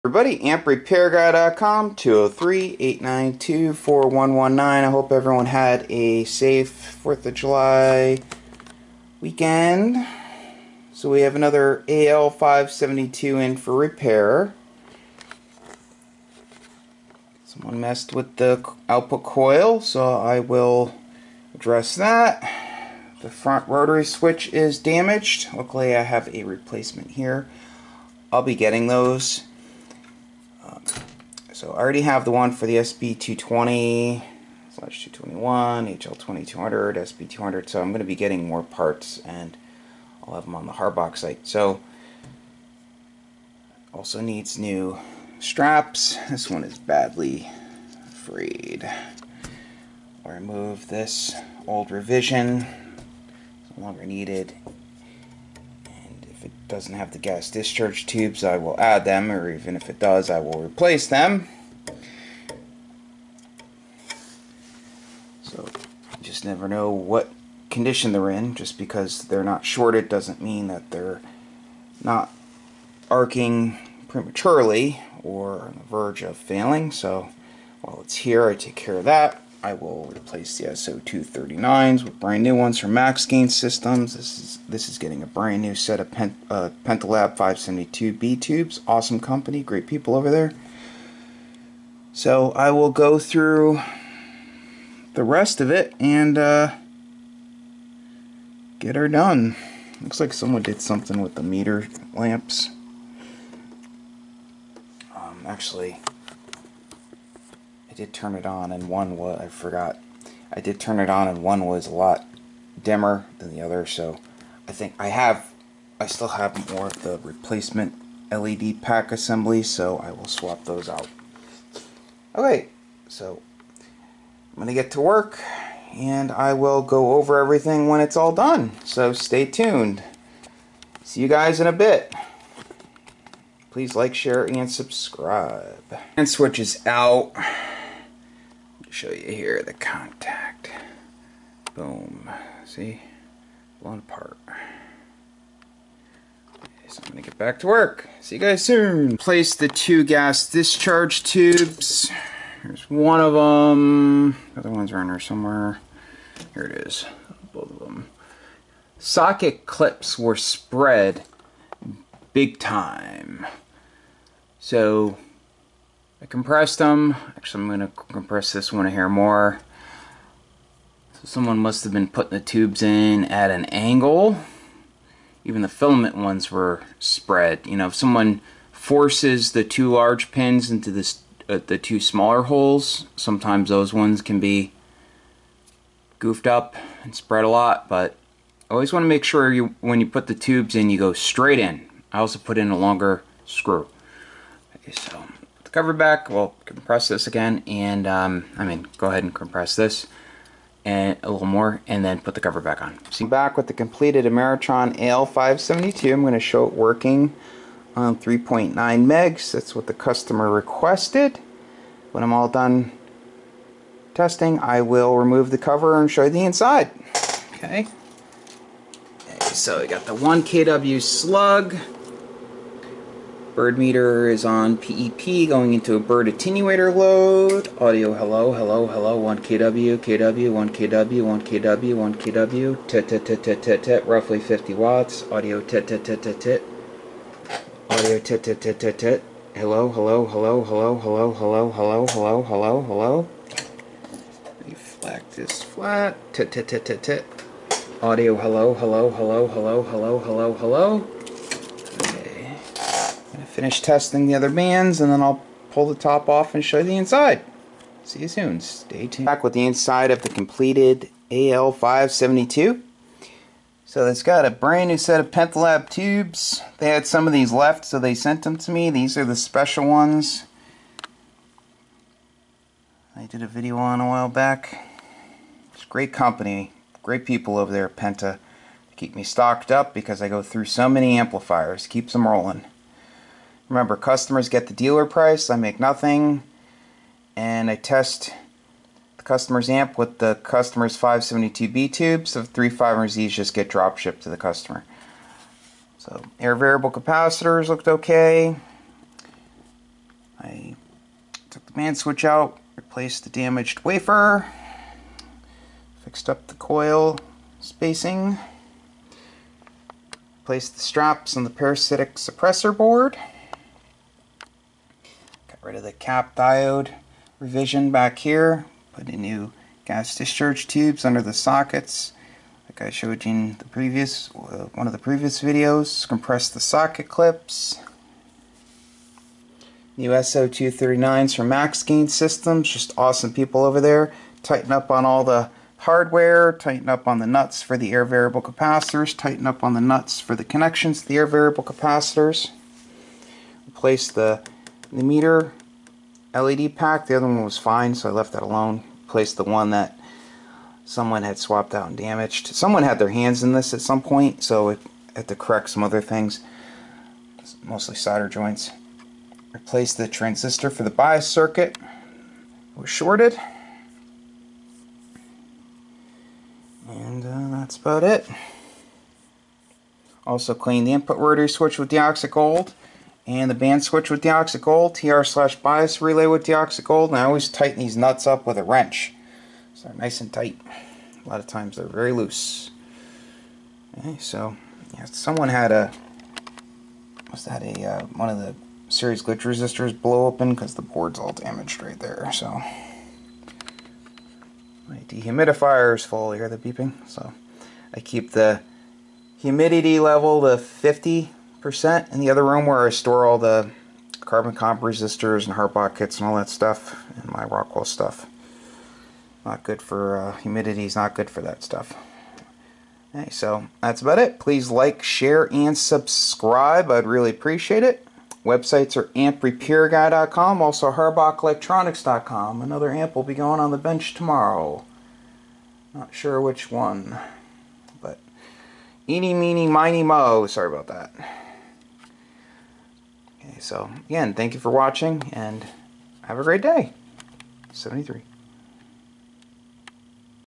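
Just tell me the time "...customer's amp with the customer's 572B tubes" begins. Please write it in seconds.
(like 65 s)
289 s.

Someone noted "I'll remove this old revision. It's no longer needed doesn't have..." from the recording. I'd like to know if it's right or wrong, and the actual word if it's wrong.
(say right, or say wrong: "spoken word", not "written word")
right.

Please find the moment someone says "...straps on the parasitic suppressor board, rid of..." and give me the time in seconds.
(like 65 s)
310 s.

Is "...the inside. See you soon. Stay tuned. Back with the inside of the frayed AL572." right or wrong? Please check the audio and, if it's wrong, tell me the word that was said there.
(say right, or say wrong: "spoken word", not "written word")
wrong: "completed", not "frayed".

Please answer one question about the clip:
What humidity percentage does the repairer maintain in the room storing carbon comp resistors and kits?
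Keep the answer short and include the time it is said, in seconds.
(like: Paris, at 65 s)
50 percent, at 400 s.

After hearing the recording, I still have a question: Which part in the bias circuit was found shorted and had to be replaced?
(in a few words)
transistor.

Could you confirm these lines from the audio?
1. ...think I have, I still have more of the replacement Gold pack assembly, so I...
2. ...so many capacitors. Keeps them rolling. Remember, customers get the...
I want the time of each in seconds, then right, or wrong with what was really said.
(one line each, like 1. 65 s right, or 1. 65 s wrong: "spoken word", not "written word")
1. 114 s wrong: "LED", not "Gold"
2. 280 s wrong: "amplifiers", not "capacitors".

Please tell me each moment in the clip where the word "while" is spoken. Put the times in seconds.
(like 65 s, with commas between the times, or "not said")
77 s, 274 s.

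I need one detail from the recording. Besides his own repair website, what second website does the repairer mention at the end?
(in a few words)
harbachelectronics.com.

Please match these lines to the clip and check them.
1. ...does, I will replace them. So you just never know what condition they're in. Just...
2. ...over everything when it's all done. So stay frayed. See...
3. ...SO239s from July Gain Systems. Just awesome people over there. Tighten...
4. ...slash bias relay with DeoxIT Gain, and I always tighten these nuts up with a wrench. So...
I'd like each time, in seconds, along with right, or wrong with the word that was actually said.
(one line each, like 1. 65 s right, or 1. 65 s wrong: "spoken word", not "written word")
1. 59 s right
2. 127 s wrong: "tuned", not "frayed"
3. 330 s wrong: "Max", not "July"
4. 375 s wrong: "Gold", not "Gain".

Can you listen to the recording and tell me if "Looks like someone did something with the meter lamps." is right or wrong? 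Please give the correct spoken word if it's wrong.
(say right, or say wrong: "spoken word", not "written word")
right.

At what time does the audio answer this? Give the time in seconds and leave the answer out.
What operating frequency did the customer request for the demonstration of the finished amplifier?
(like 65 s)
208 s.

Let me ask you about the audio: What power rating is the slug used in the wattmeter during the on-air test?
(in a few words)
1 kW.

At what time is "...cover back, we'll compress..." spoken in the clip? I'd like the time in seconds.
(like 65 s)
195 s.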